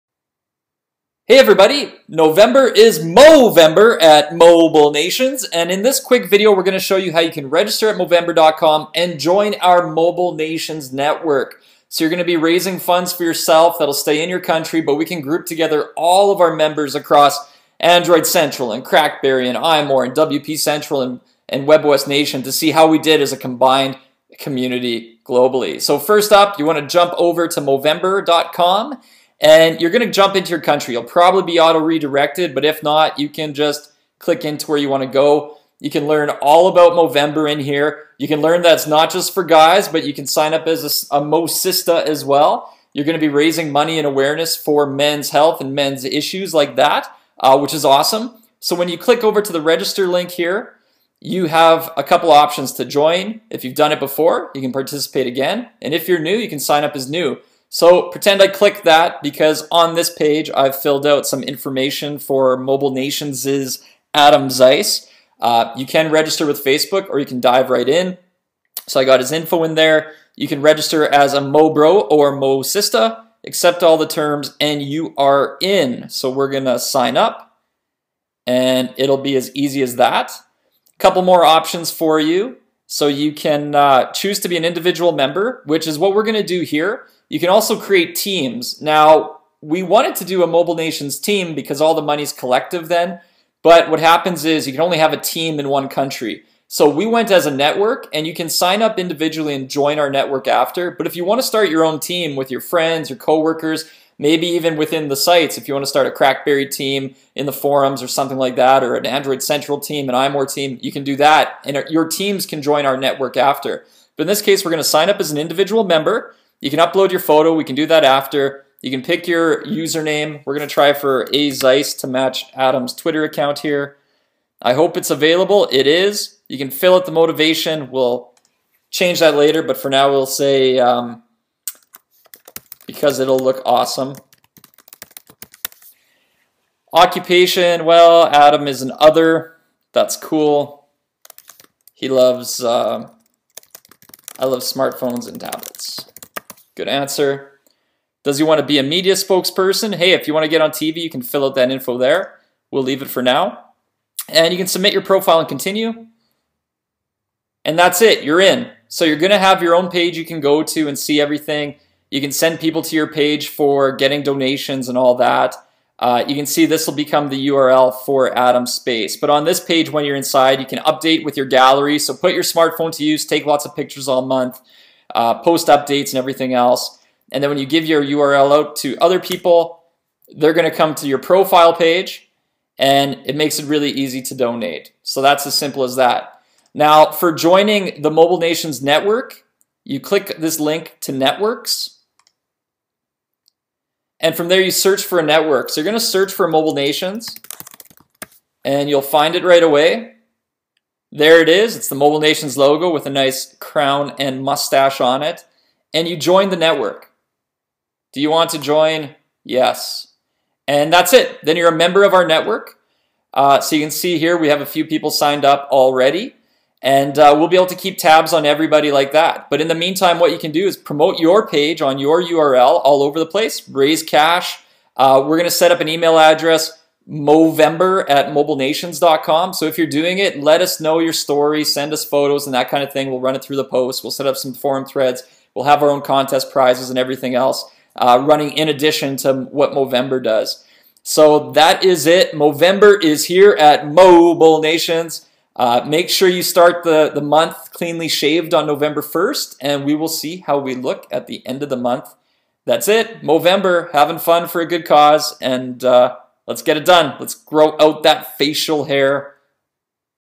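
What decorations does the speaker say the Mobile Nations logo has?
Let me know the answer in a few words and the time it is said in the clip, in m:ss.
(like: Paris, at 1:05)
Crown and mustache, at 3:23.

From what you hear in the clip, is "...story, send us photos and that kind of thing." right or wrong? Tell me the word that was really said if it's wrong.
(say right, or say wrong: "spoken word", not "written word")
right.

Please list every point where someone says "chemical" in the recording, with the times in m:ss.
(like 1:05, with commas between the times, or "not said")
not said.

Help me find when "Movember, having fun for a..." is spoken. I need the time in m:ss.
4:13.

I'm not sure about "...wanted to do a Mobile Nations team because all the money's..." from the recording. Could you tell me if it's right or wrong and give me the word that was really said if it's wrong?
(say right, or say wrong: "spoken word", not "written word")
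right.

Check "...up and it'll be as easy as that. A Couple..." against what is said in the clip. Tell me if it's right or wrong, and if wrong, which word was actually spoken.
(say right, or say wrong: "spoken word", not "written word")
right.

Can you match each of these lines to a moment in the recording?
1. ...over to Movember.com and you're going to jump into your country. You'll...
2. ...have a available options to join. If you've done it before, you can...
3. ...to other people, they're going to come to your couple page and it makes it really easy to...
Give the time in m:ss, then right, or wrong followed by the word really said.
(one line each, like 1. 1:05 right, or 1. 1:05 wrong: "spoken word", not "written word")
1. 0:27 right
2. 0:51 wrong: "couple", not "available"
3. 2:58 wrong: "profile", not "couple".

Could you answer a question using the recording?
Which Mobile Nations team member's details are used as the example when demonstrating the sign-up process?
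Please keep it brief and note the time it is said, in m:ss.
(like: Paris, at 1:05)
Adam Zeis, at 1:04.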